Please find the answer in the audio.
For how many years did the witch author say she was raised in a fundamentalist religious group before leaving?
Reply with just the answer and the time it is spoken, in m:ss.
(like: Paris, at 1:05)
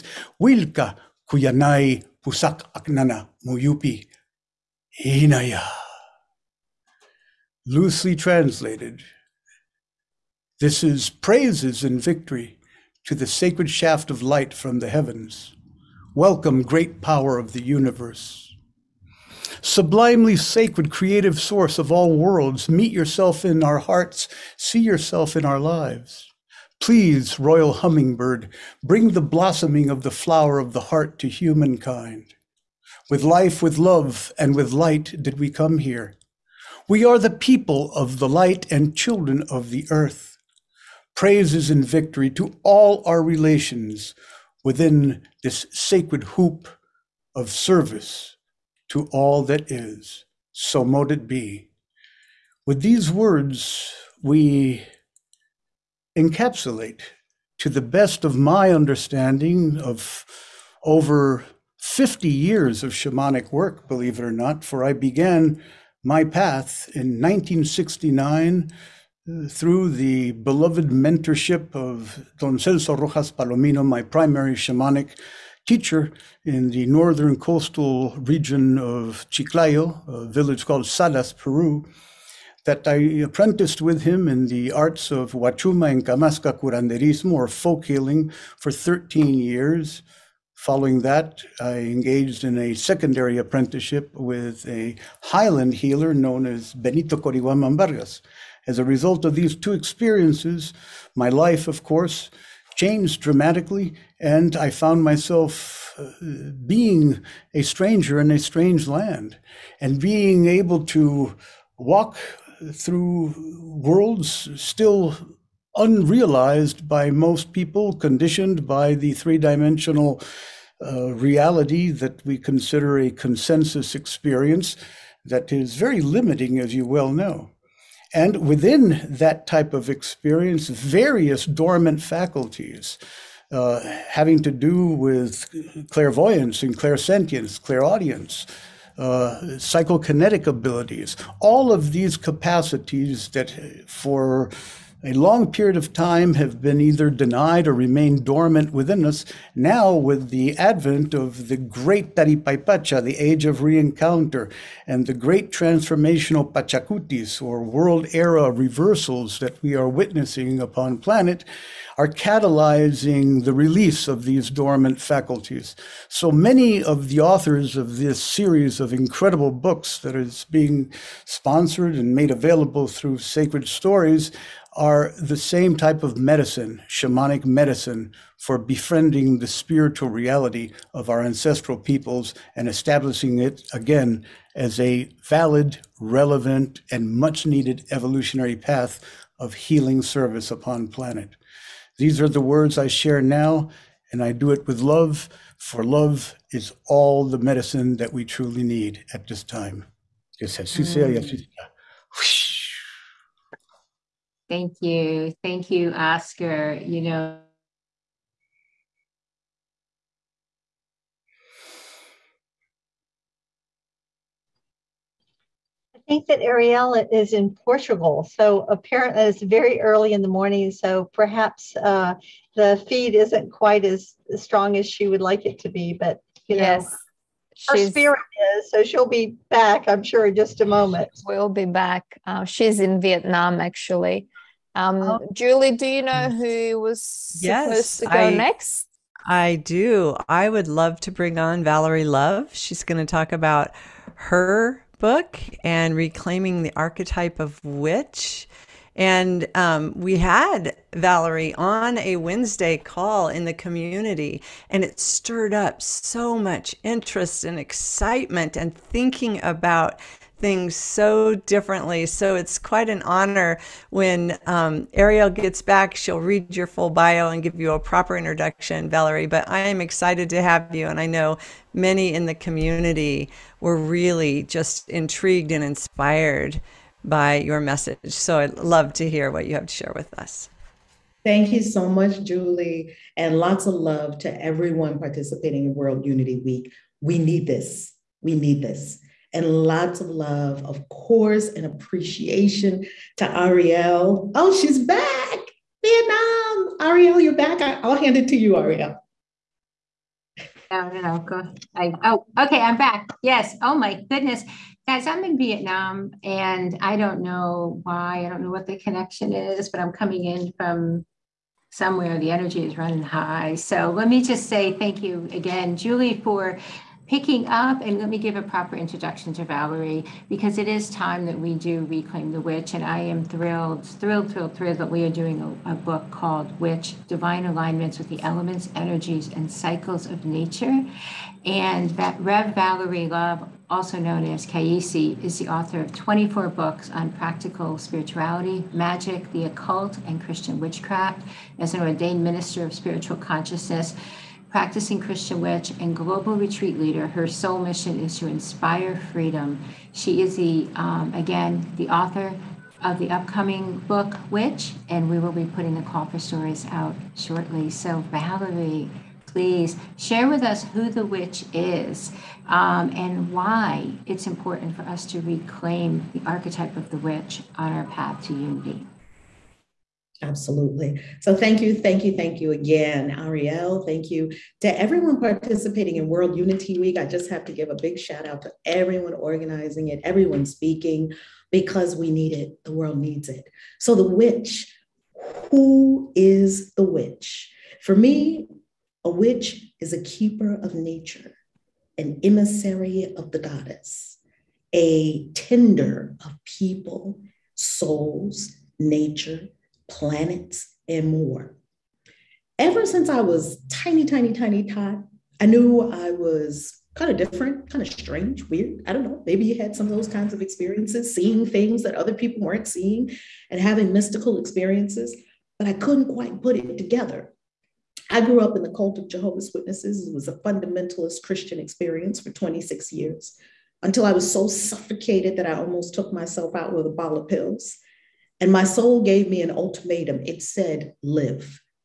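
26, at 7:02.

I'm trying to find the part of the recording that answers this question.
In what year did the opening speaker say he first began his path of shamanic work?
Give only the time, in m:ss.
1:07.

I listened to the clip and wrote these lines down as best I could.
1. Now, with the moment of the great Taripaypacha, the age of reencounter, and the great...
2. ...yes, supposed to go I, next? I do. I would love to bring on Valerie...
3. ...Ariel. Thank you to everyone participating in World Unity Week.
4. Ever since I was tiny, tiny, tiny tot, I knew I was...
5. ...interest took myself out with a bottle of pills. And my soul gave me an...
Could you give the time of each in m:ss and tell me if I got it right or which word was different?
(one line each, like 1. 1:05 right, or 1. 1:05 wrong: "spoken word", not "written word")
1. 2:29 wrong: "advent", not "moment"
2. 3:57 right
3. 6:13 right
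4. 6:42 right
5. 7:05 wrong: "almost", not "interest".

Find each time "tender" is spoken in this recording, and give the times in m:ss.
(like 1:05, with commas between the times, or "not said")
6:35.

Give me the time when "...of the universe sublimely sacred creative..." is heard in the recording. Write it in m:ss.
0:17.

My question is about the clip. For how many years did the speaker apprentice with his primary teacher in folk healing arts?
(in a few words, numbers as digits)
13.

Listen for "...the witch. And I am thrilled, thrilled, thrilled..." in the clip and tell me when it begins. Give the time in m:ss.
5:22.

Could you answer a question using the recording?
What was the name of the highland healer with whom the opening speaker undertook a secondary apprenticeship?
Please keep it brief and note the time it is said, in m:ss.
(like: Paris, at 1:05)
Benito Corihuaman Vargas, at 1:36.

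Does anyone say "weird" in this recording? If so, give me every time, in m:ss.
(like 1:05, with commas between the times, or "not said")
6:48.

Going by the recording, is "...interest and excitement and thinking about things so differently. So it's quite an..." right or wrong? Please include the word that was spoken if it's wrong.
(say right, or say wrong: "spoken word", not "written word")
right.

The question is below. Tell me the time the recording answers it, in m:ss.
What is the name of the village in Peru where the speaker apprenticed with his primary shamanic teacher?
1:20.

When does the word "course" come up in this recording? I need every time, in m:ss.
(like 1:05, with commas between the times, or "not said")
1:41, 4:50.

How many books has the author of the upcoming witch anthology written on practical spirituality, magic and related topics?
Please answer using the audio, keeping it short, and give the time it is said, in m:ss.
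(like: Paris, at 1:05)
24, at 5:35.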